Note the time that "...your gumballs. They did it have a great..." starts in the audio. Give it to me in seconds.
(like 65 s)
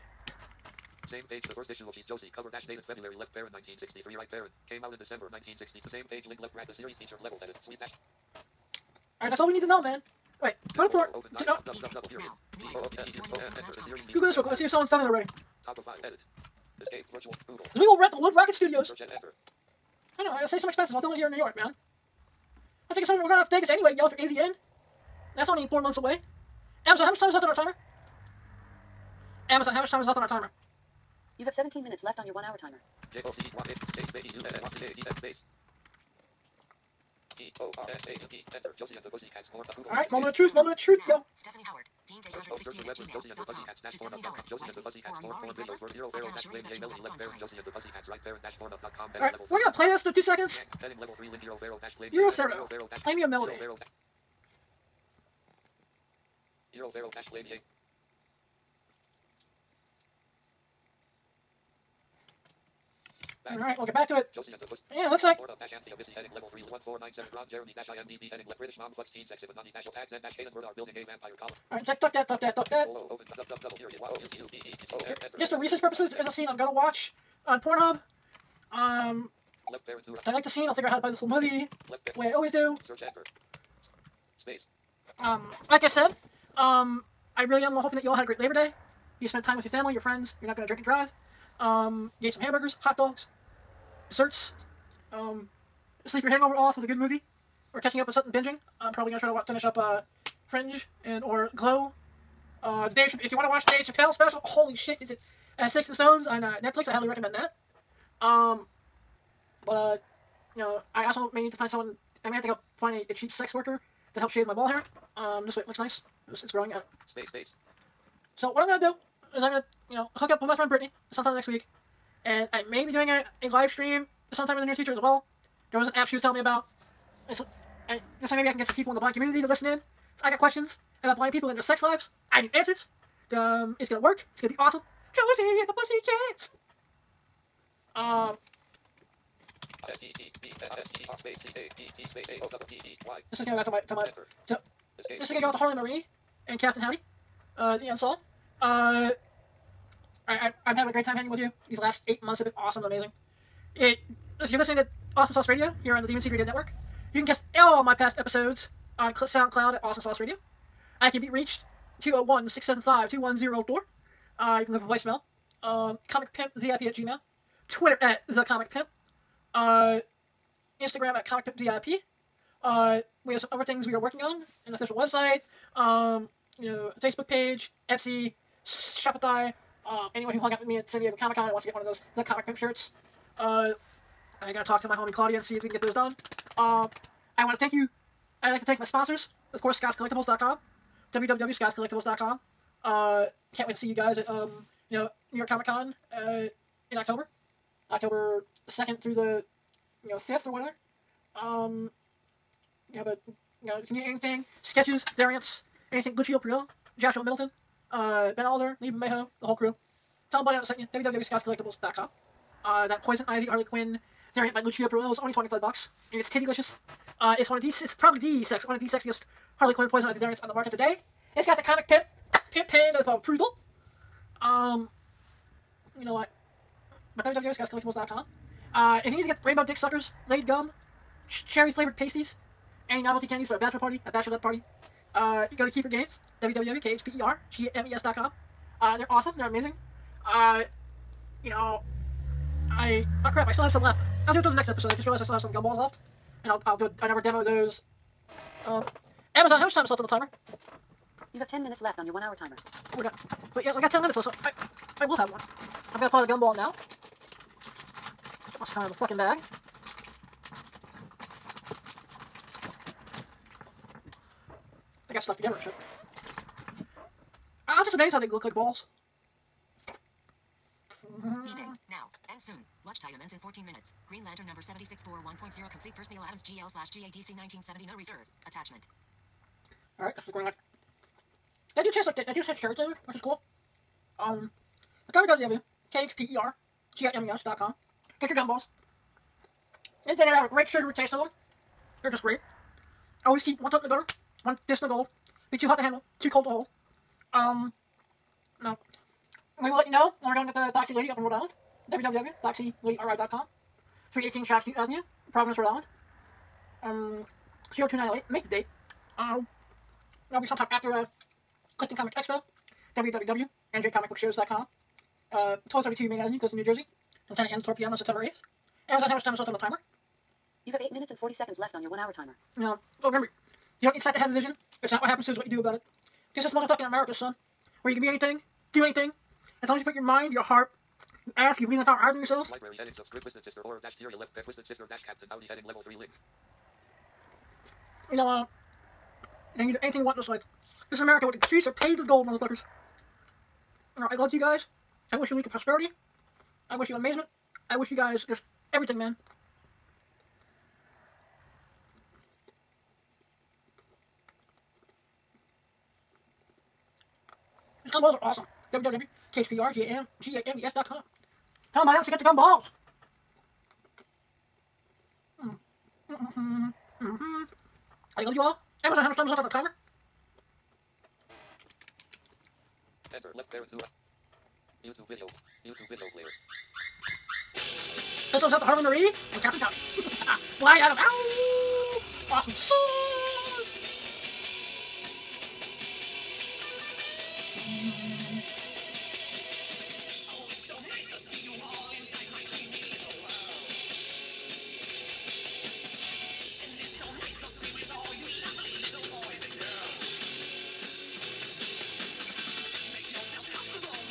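288 s.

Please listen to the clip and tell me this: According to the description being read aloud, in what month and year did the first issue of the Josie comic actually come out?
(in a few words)
December 1960.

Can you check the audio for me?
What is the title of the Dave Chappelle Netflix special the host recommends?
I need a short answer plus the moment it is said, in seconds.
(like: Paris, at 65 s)
Sticks and Stones, at 105 s.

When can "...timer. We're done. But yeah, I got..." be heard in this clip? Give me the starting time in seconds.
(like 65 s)
252 s.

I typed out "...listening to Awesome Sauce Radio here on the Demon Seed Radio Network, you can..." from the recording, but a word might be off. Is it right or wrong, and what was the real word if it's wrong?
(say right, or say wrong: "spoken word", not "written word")
right.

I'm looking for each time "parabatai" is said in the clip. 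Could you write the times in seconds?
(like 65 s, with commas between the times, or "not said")
not said.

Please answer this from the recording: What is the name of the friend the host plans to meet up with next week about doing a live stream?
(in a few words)
Brittany.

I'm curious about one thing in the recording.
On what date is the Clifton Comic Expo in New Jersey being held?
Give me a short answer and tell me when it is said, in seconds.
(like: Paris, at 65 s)
September 8, at 317 s.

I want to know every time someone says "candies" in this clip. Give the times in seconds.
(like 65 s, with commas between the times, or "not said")
233 s.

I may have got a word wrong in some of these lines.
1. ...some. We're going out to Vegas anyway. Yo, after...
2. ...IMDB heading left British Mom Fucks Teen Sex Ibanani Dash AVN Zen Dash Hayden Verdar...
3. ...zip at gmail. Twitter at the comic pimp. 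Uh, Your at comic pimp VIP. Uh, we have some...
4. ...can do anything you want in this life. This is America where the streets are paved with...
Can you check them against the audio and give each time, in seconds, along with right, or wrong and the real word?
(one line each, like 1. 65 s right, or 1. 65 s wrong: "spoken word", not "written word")
1. 23 s right
2. 67 s wrong: "Otak", not "AVN"
3. 166 s wrong: "Instagram", not "Your"
4. 339 s right.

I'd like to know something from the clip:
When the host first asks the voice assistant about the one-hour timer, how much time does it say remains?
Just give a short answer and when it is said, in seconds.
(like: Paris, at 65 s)
17 minutes, at 31 s.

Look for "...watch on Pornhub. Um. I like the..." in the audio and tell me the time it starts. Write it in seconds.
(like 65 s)
76 s.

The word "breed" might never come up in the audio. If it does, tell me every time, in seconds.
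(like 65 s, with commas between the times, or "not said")
not said.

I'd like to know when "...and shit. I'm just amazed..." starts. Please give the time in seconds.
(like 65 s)
265 s.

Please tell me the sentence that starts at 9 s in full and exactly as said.
Alright, that's all we need to know, man.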